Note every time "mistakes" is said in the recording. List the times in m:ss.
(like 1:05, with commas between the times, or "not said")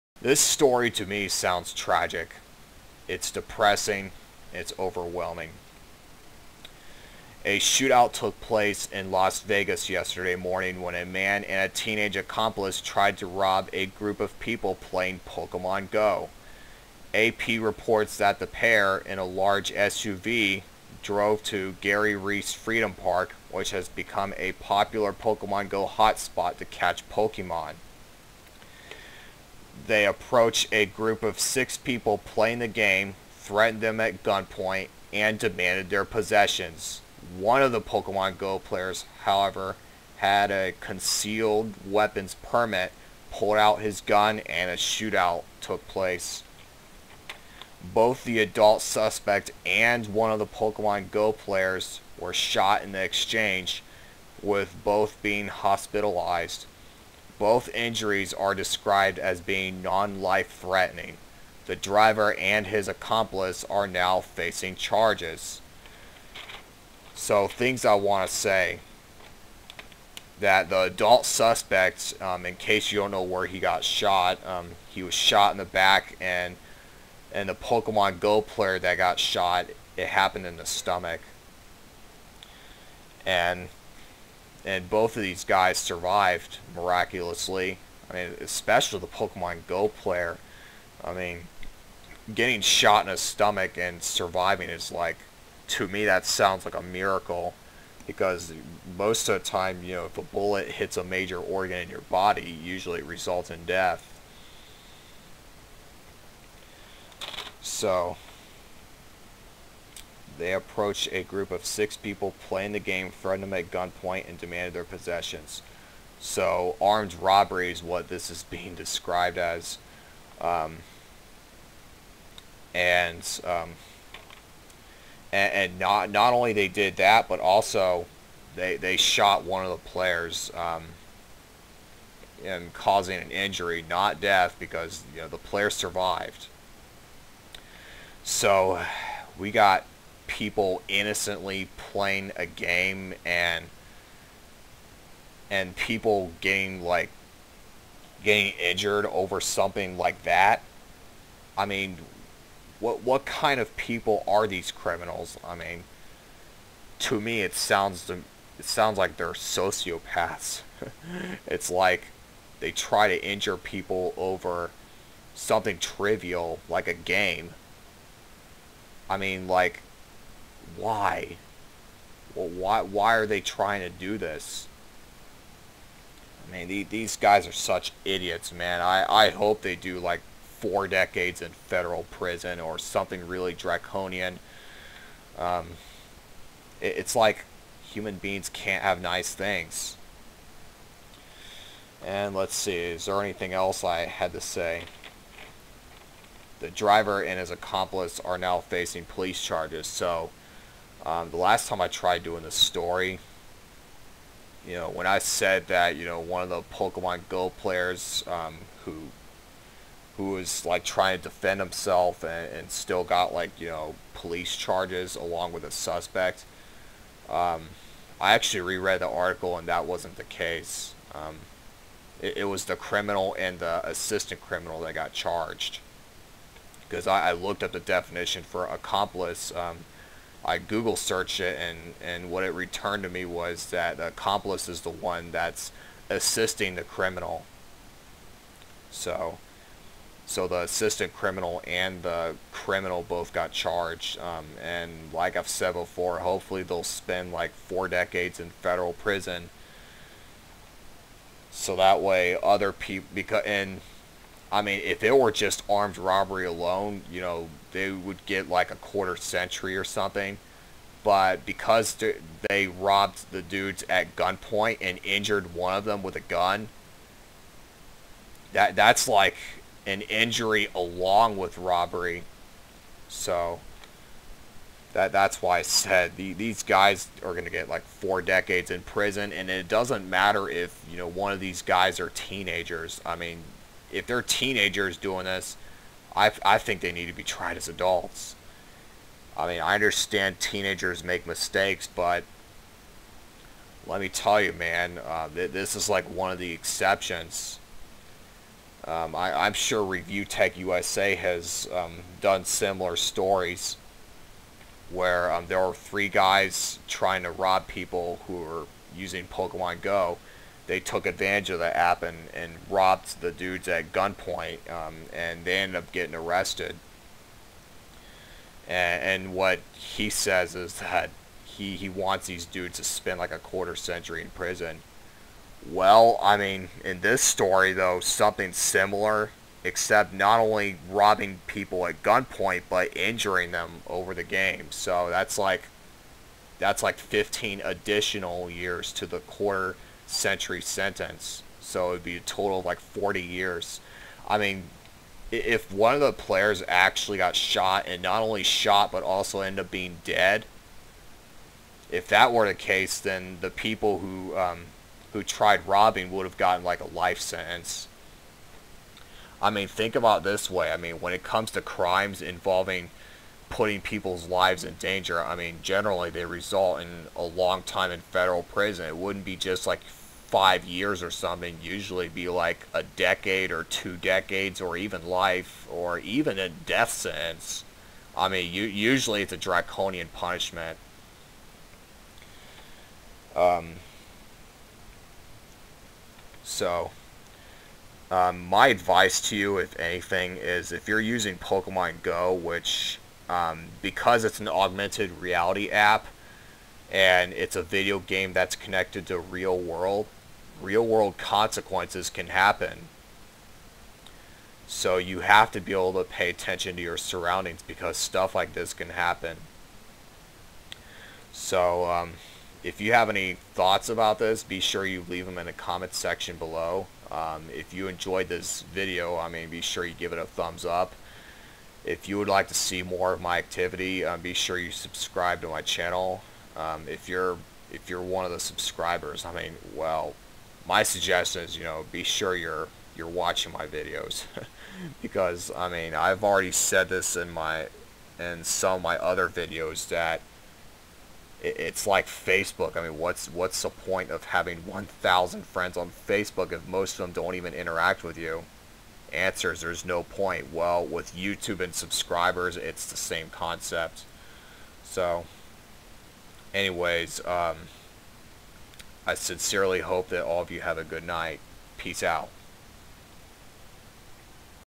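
4:51.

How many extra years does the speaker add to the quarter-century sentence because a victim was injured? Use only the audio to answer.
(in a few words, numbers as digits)
15.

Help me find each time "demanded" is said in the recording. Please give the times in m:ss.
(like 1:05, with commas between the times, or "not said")
0:35, 1:54.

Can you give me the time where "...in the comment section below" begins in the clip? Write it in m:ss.
6:55.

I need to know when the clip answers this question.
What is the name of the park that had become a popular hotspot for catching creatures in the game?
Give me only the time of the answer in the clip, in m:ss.
0:21.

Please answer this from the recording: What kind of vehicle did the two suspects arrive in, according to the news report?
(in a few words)
SUV.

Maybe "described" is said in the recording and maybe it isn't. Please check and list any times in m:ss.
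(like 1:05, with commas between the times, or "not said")
0:58, 1:58.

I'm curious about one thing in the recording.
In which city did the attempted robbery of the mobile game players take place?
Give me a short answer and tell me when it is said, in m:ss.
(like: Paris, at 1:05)
Las Vegas, at 0:09.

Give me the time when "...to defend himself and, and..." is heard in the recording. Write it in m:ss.
3:31.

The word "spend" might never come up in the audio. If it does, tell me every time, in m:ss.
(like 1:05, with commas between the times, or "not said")
4:06, 5:22.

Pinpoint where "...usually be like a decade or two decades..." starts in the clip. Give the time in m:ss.
6:11.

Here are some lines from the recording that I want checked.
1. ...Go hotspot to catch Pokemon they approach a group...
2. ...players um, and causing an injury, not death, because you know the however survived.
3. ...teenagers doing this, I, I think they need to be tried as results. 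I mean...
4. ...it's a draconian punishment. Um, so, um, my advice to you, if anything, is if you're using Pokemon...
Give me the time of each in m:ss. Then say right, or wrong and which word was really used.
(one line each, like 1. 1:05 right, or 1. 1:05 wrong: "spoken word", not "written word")
1. 0:25 right
2. 2:09 wrong: "player", not "however"
3. 4:44 wrong: "adults", not "results"
4. 6:19 right.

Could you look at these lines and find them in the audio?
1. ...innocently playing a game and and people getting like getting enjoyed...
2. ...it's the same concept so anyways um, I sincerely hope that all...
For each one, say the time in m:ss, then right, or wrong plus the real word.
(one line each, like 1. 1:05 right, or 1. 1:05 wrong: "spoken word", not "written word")
1. 2:20 wrong: "injured", not "enjoyed"
2. 7:32 right.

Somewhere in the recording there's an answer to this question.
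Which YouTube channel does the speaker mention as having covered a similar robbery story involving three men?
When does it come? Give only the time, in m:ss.
4:59.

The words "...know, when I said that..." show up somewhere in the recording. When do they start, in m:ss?
3:24.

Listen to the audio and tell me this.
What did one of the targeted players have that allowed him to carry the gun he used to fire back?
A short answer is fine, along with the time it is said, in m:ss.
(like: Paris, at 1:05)
concealed weapons permit, at 0:40.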